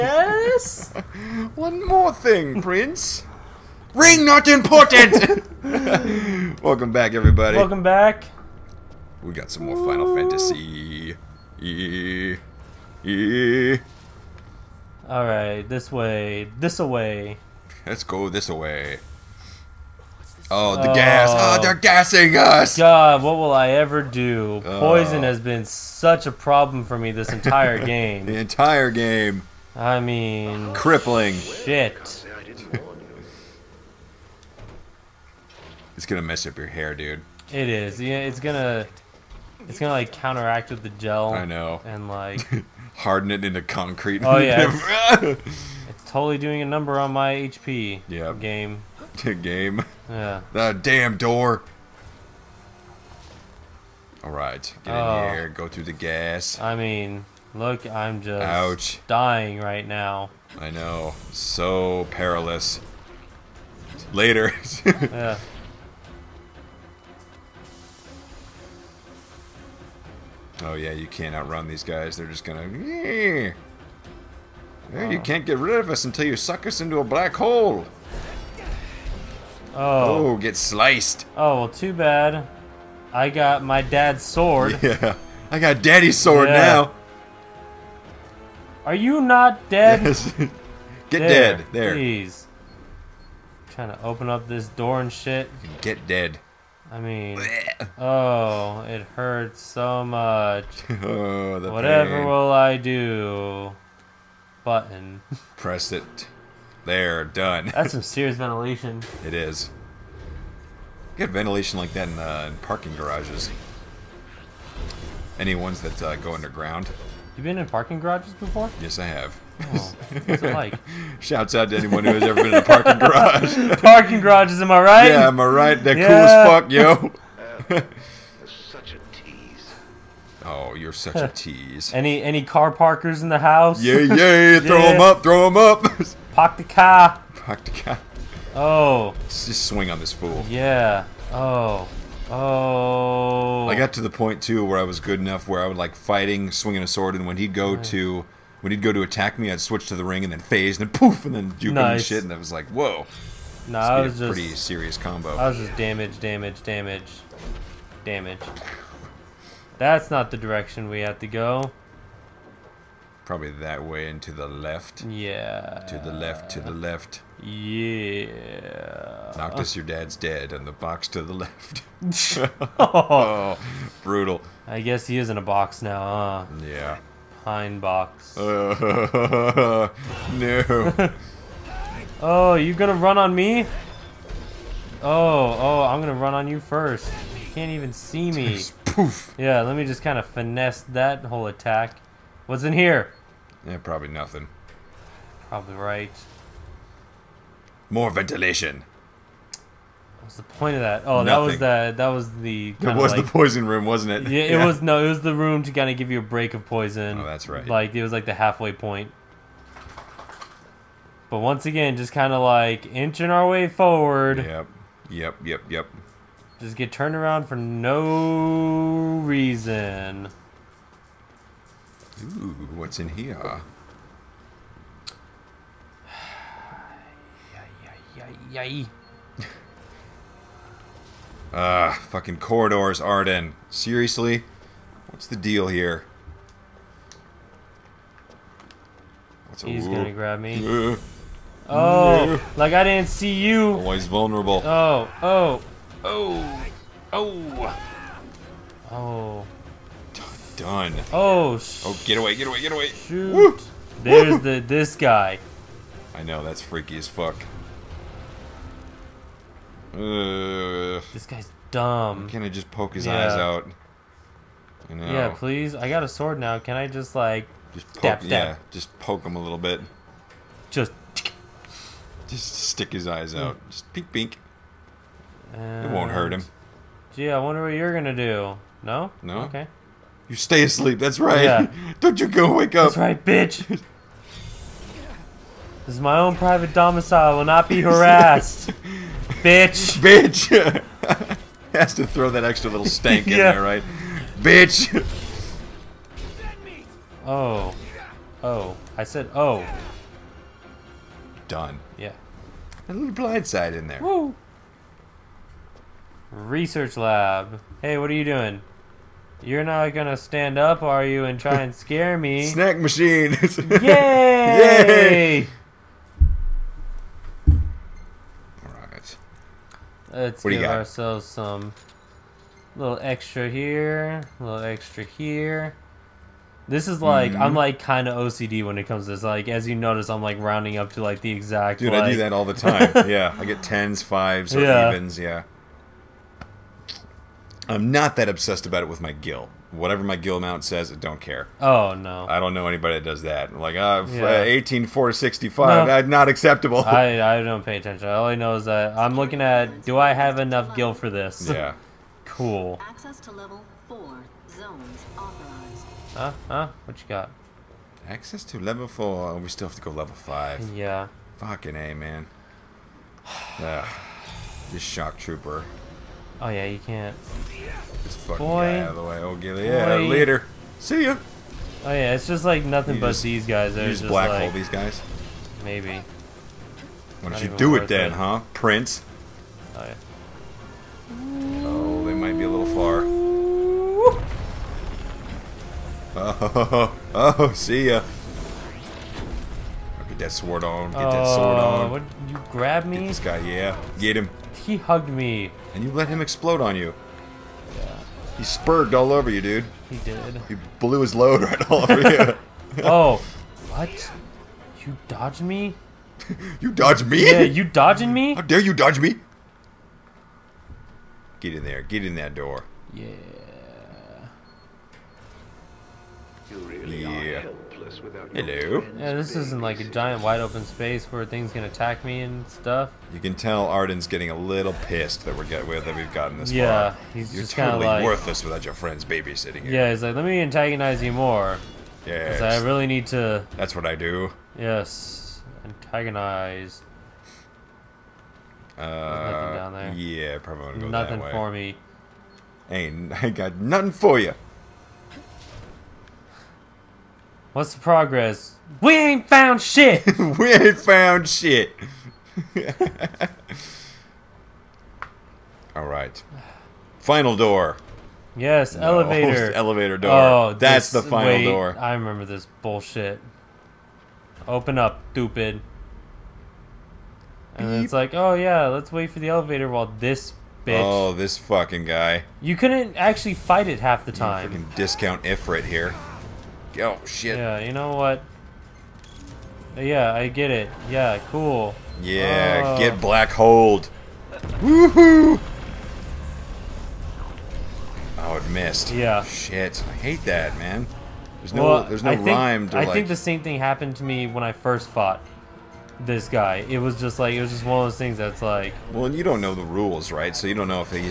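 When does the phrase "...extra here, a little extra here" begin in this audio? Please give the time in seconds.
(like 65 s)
323 s.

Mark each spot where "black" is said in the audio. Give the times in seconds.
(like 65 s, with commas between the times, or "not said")
77 s, 374 s, 483 s.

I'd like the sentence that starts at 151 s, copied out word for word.
and shit, and I was like, whoa.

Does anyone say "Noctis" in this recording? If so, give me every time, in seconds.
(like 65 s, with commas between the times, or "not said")
169 s.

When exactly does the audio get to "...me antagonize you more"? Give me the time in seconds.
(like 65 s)
430 s.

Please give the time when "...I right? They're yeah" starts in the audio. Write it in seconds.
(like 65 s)
125 s.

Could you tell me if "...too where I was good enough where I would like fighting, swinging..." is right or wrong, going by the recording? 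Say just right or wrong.
right.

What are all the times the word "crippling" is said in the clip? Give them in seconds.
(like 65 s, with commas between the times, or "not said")
30 s.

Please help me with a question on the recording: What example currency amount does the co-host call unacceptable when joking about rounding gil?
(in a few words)
1865.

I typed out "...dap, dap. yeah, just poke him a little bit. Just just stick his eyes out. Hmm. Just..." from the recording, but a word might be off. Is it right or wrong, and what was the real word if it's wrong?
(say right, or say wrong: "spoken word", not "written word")
right.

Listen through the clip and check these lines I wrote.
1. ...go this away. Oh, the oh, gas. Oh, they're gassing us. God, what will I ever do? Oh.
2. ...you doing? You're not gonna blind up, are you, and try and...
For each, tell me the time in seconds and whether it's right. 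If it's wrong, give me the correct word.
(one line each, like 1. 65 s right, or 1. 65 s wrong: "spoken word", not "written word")
1. 18 s right
2. 308 s wrong: "stand", not "blind".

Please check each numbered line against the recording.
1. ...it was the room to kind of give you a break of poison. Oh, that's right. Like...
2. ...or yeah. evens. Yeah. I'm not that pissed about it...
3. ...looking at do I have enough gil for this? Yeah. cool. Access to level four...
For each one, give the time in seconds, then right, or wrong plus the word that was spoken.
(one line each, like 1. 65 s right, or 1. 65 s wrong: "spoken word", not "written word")
1. 205 s right
2. 334 s wrong: "obsessed", not "pissed"
3. 349 s right.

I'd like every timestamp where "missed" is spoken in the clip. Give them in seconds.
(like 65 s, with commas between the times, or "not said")
488 s.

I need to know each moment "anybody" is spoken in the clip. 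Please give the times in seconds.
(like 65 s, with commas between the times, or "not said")
342 s.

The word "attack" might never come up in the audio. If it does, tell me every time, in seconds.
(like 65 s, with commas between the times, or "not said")
149 s, 191 s, 421 s.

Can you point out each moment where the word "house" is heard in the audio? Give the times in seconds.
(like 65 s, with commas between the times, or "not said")
133 s.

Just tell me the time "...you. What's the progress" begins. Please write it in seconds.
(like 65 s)
444 s.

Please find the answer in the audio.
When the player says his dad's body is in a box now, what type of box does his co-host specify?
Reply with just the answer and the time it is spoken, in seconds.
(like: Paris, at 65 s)
Pine box, at 177 s.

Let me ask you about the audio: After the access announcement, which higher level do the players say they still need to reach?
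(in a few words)
Level five.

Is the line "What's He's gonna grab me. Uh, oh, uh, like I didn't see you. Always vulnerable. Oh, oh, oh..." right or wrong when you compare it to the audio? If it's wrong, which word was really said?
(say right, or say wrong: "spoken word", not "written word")
right.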